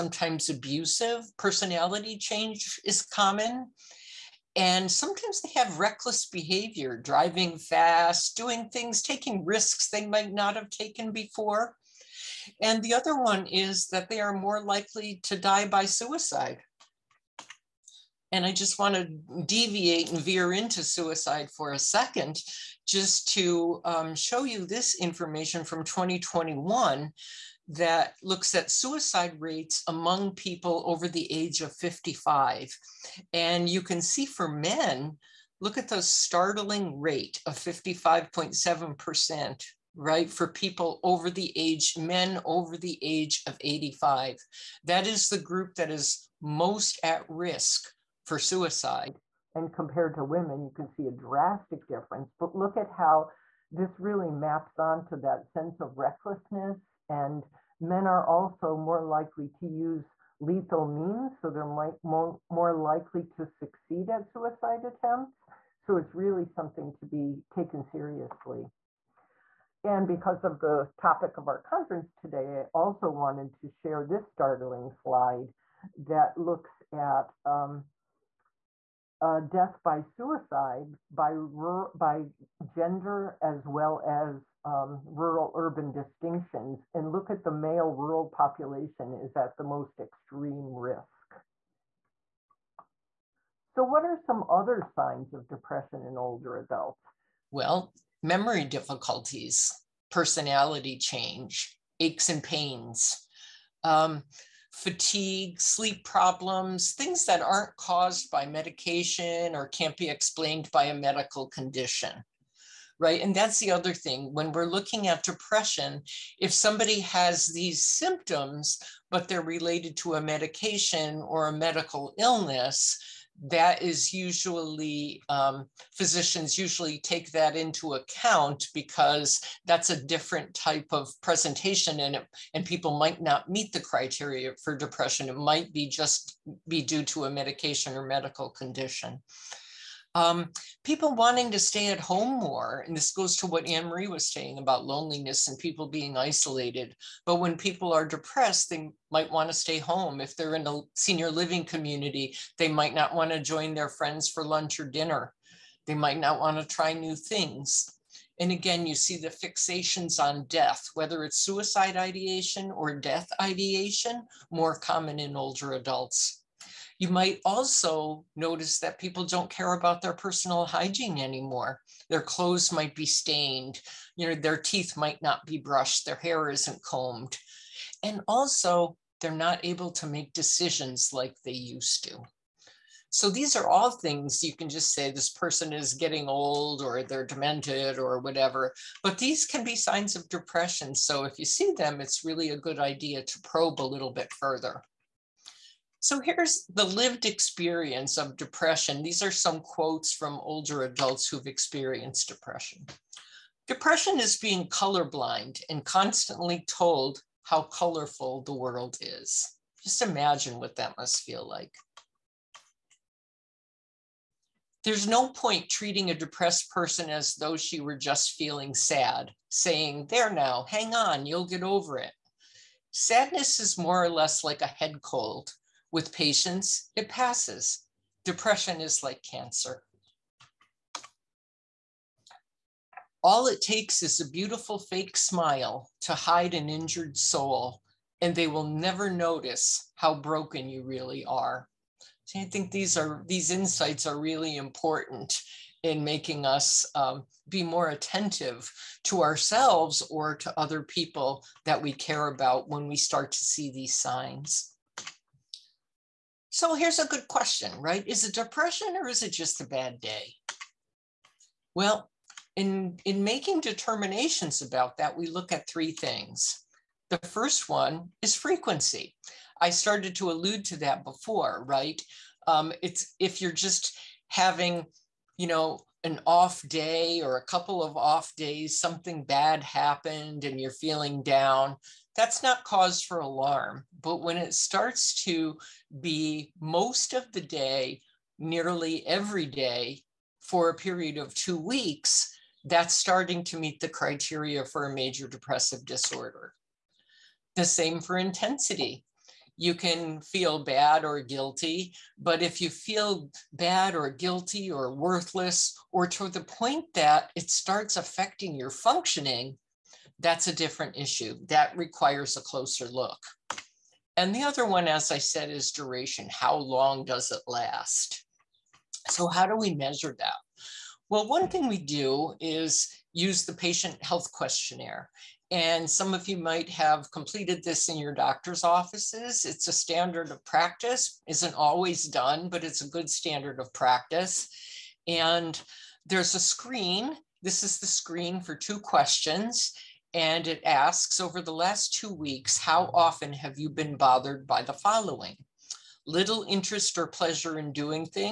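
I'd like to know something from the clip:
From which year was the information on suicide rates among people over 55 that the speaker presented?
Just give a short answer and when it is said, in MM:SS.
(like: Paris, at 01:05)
2021, at 00:25.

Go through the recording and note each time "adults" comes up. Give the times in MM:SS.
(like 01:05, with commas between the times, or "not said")
01:36, 02:45, 03:20.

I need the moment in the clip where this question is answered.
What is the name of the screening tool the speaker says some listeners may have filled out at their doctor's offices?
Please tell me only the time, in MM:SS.
05:23.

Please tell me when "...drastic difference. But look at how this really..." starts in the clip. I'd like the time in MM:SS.
00:51.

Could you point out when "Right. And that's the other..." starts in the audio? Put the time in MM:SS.
01:52.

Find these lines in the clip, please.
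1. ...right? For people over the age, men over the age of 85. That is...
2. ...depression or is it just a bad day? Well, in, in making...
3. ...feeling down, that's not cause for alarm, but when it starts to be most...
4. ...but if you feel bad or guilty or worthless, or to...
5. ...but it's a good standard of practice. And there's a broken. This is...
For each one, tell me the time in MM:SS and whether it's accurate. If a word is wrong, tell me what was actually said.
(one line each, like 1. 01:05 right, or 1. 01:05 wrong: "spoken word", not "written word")
1. 00:39 right
2. 04:18 right
3. 04:40 right
4. 05:02 right
5. 05:32 wrong: "screen", not "broken".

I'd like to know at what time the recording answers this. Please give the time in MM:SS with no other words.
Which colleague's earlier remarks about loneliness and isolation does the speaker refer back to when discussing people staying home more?
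02:23.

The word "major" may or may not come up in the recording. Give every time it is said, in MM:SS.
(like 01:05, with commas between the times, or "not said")
04:54.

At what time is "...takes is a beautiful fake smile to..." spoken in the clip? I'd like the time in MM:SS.
03:53.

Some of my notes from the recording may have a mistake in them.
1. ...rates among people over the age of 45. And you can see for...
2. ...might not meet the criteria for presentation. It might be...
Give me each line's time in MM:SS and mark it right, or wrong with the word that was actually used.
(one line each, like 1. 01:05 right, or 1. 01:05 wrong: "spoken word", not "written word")
1. 00:29 wrong: "55", not "45"
2. 02:12 wrong: "depression", not "presentation".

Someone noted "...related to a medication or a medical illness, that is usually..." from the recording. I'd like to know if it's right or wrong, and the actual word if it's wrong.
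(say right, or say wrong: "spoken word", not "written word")
right.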